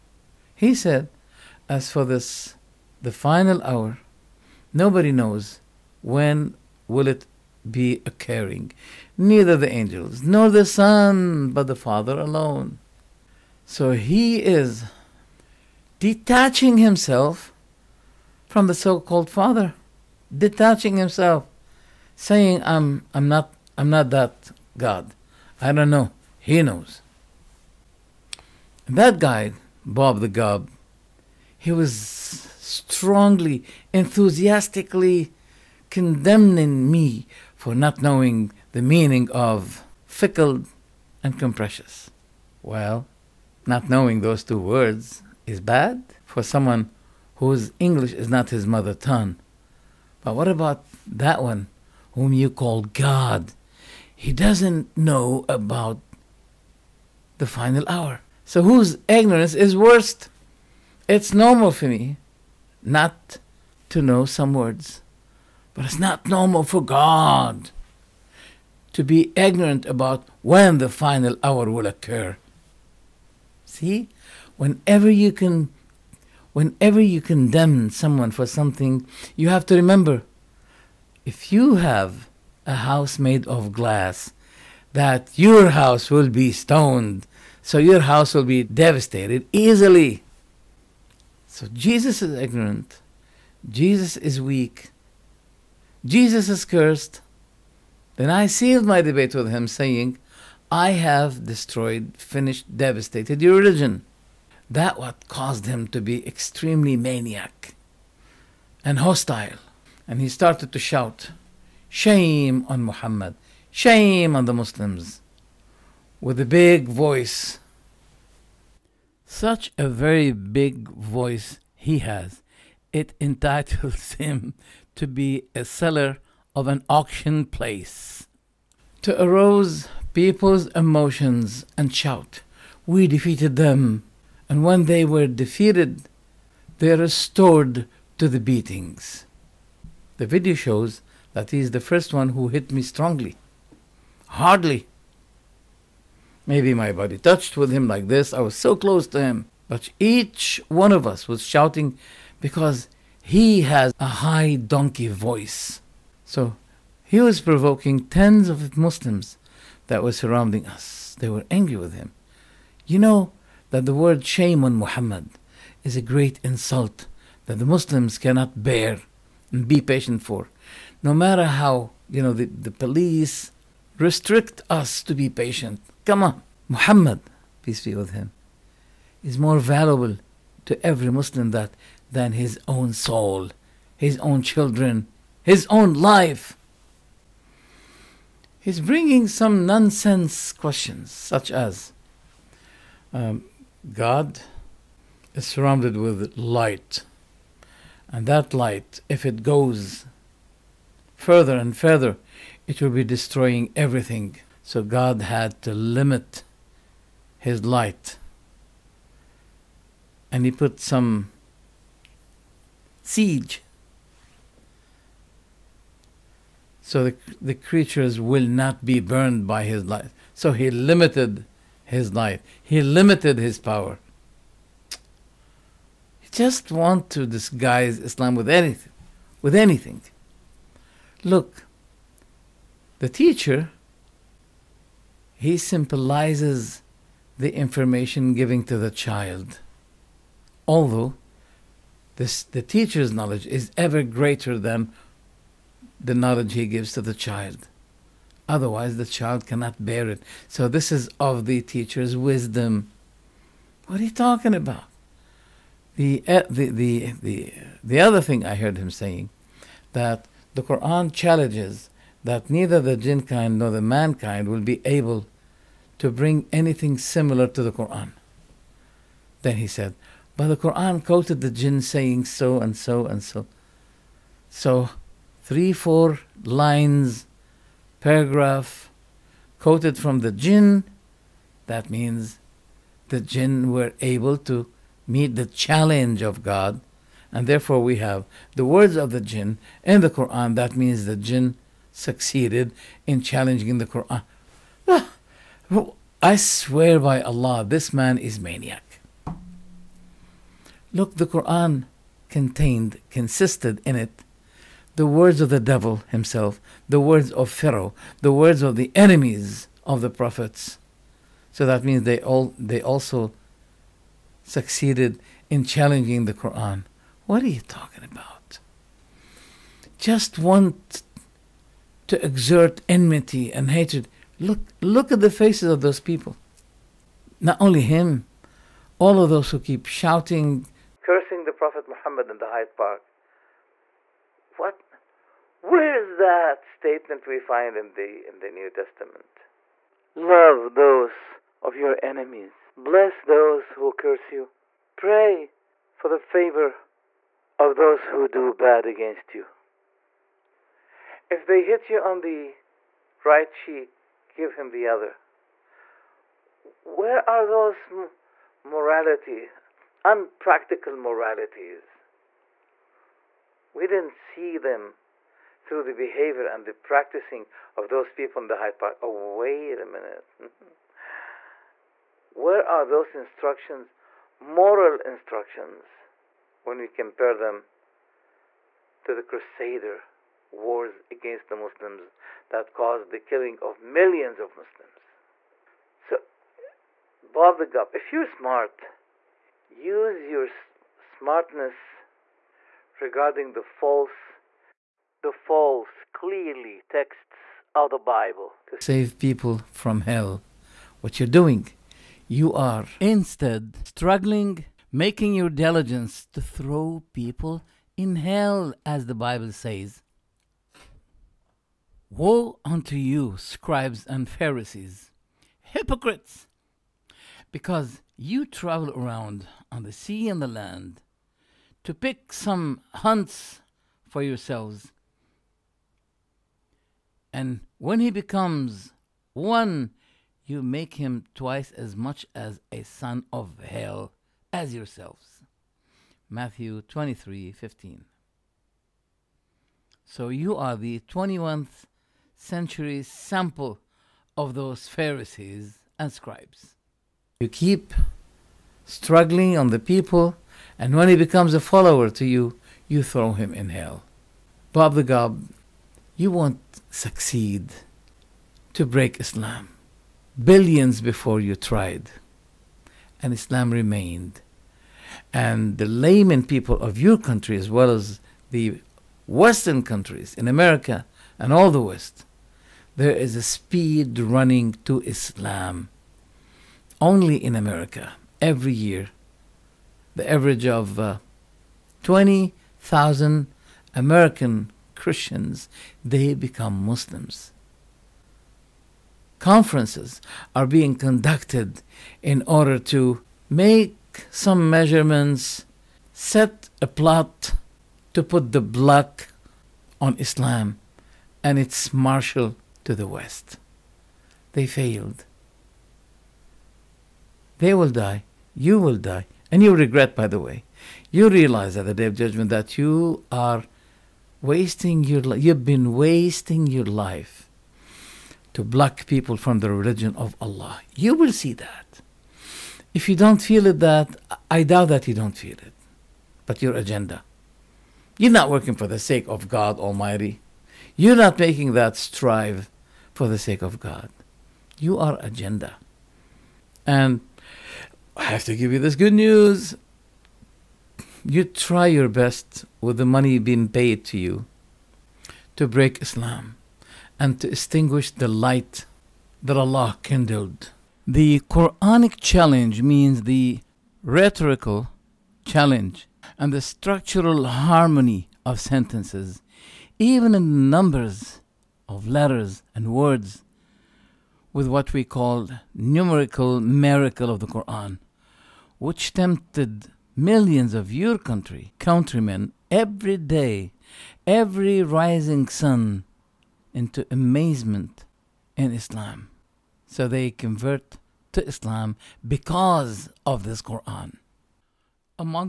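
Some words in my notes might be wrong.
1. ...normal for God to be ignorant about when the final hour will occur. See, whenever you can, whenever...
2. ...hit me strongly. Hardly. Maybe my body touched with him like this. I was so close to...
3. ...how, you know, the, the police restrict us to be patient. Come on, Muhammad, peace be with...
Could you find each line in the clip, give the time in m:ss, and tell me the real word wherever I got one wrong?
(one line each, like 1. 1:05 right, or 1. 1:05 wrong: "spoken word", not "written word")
1. 1:06 right
2. 2:22 right
3. 2:51 right.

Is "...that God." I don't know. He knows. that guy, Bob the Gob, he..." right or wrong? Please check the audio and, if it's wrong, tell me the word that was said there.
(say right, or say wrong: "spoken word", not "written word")
right.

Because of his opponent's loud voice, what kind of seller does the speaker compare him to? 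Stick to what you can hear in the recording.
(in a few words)
seller of an auction place.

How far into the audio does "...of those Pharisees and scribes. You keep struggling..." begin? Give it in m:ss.
7:24.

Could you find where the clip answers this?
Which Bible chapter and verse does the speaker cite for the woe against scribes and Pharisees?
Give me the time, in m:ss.
7:16.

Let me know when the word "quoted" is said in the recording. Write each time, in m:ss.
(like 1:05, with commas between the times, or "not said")
4:31, 4:39.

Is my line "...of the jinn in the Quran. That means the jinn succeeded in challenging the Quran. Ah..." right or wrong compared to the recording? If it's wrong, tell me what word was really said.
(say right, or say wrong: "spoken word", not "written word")
right.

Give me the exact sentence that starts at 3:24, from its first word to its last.
So God had to limit his light.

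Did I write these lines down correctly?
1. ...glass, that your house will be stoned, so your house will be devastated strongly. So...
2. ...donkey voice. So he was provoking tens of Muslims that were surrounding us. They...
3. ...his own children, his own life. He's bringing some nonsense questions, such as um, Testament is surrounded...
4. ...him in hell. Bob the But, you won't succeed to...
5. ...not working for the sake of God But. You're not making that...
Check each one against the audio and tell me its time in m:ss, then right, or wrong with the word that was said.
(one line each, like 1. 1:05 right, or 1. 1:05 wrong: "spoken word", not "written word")
1. 1:23 wrong: "easily", not "strongly"
2. 2:34 right
3. 3:03 wrong: "God", not "Testament"
4. 7:33 wrong: "Gob", not "But"
5. 8:48 wrong: "Almighty", not "But".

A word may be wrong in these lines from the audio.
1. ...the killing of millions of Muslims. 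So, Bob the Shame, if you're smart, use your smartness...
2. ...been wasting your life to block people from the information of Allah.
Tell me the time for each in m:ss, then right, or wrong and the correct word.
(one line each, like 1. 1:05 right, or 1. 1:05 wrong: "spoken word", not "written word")
1. 6:23 wrong: "Gob", not "Shame"
2. 8:35 wrong: "religion", not "information".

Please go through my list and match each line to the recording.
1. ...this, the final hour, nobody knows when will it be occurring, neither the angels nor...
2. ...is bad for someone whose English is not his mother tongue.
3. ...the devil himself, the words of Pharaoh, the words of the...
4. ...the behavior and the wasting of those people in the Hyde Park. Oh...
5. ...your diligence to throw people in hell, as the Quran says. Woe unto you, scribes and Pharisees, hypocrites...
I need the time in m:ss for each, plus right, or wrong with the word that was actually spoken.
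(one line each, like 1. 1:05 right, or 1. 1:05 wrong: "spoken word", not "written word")
1. 0:02 right
2. 0:45 right
3. 5:05 right
4. 6:05 wrong: "practicing", not "wasting"
5. 6:45 wrong: "Bible", not "Quran".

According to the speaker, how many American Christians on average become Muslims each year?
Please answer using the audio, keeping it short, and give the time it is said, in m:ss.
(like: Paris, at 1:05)
20,000, at 8:02.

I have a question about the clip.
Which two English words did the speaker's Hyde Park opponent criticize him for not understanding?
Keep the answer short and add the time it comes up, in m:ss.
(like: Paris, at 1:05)
fickle and capricious, at 0:40.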